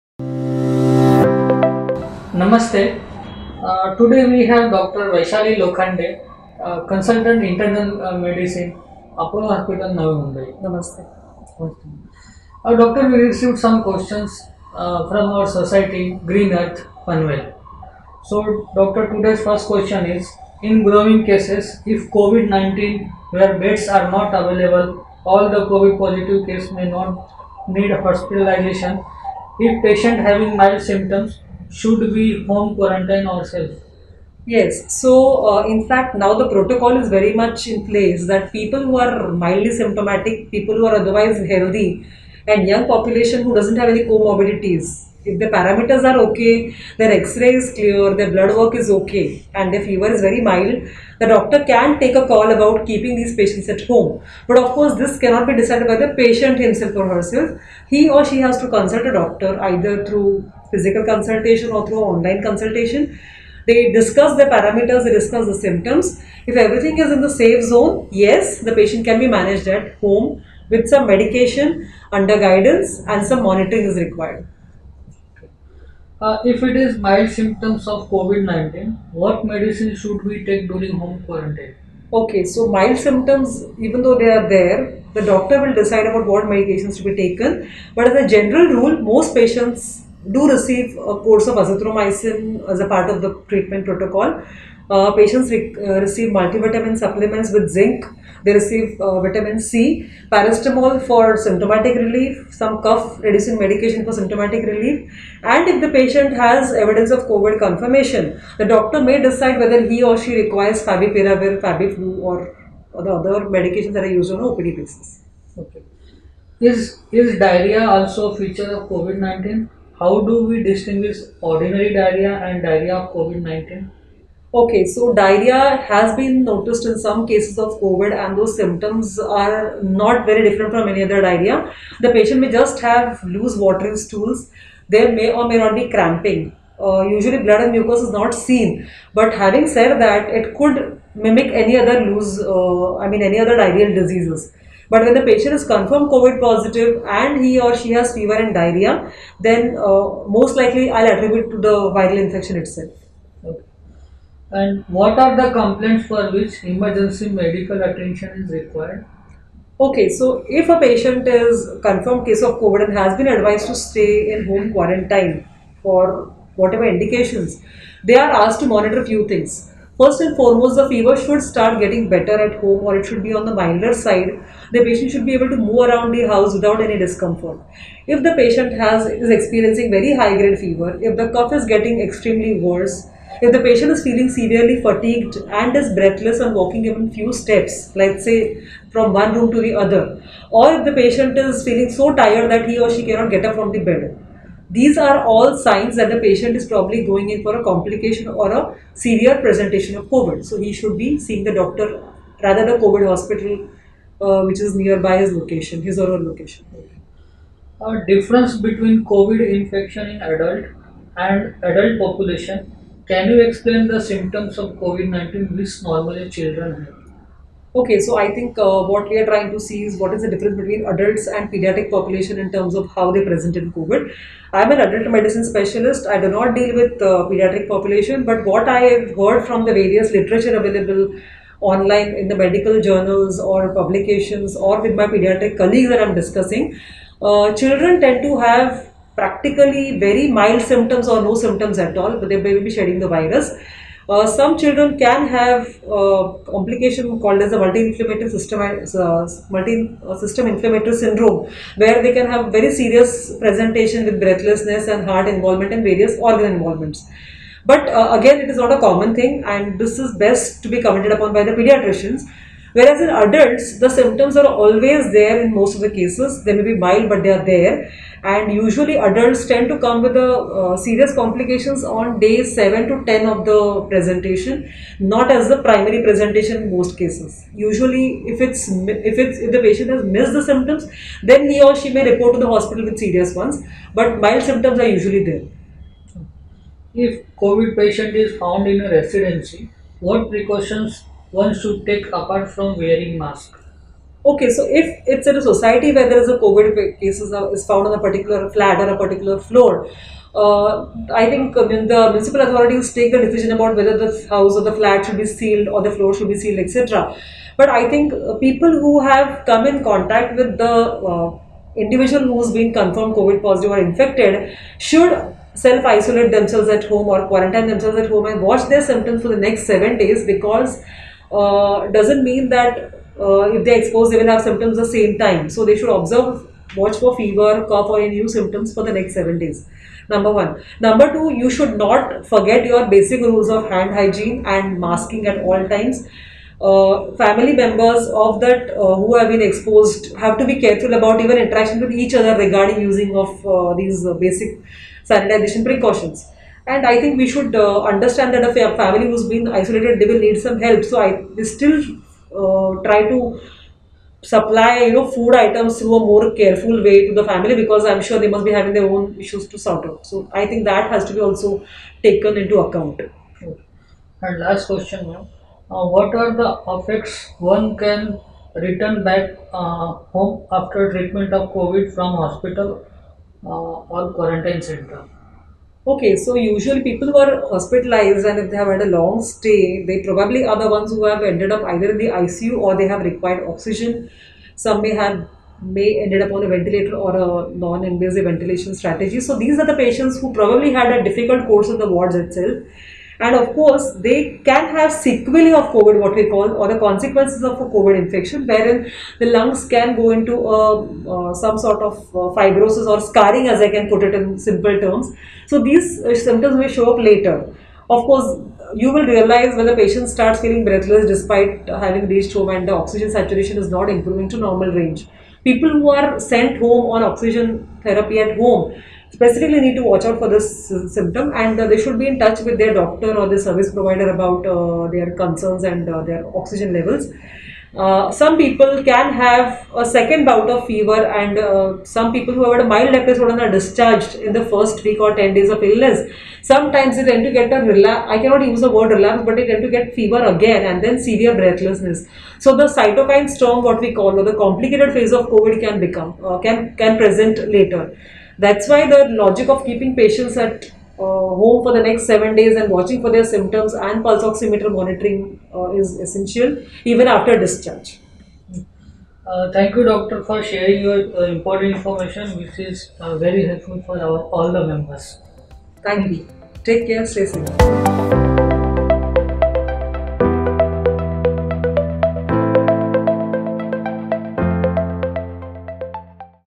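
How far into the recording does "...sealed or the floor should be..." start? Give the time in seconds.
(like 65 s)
305 s.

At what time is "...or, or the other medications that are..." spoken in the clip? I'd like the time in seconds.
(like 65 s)
112 s.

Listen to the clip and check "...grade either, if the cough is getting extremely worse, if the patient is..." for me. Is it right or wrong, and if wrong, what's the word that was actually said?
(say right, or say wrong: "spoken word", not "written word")
wrong: "fever", not "either".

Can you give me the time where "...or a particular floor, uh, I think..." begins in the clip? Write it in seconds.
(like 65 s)
298 s.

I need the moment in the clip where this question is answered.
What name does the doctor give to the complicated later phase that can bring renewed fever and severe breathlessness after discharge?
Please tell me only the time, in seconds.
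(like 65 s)
442 s.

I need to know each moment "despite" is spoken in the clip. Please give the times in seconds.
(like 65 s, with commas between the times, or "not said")
411 s.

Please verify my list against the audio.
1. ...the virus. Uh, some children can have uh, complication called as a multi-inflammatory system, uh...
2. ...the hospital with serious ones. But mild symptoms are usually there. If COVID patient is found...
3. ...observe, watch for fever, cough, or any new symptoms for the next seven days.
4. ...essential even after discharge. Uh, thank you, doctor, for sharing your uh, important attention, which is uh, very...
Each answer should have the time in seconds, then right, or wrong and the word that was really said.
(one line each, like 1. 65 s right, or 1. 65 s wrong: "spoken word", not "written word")
1. 242 s right
2. 282 s right
3. 325 s right
4. 456 s wrong: "information", not "attention".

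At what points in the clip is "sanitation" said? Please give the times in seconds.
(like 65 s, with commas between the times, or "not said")
345 s.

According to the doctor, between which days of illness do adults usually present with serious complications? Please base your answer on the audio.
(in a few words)
Day 7 to 10.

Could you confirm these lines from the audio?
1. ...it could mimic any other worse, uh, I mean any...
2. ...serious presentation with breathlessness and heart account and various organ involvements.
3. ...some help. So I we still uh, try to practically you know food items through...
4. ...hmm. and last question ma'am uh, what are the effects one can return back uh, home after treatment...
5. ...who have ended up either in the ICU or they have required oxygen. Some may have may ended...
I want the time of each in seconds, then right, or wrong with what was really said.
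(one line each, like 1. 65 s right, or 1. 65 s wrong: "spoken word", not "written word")
1. 140 s wrong: "loose", not "worse"
2. 252 s wrong: "involvement", not "account"
3. 350 s wrong: "supply", not "practically"
4. 363 s right
5. 380 s right.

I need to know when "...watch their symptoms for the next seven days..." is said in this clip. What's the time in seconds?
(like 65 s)
318 s.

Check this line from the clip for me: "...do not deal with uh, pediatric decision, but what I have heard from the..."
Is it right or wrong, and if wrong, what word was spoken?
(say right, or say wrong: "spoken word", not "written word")
wrong: "population", not "decision".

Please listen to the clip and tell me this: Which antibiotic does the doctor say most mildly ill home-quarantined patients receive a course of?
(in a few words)
Azithromycin.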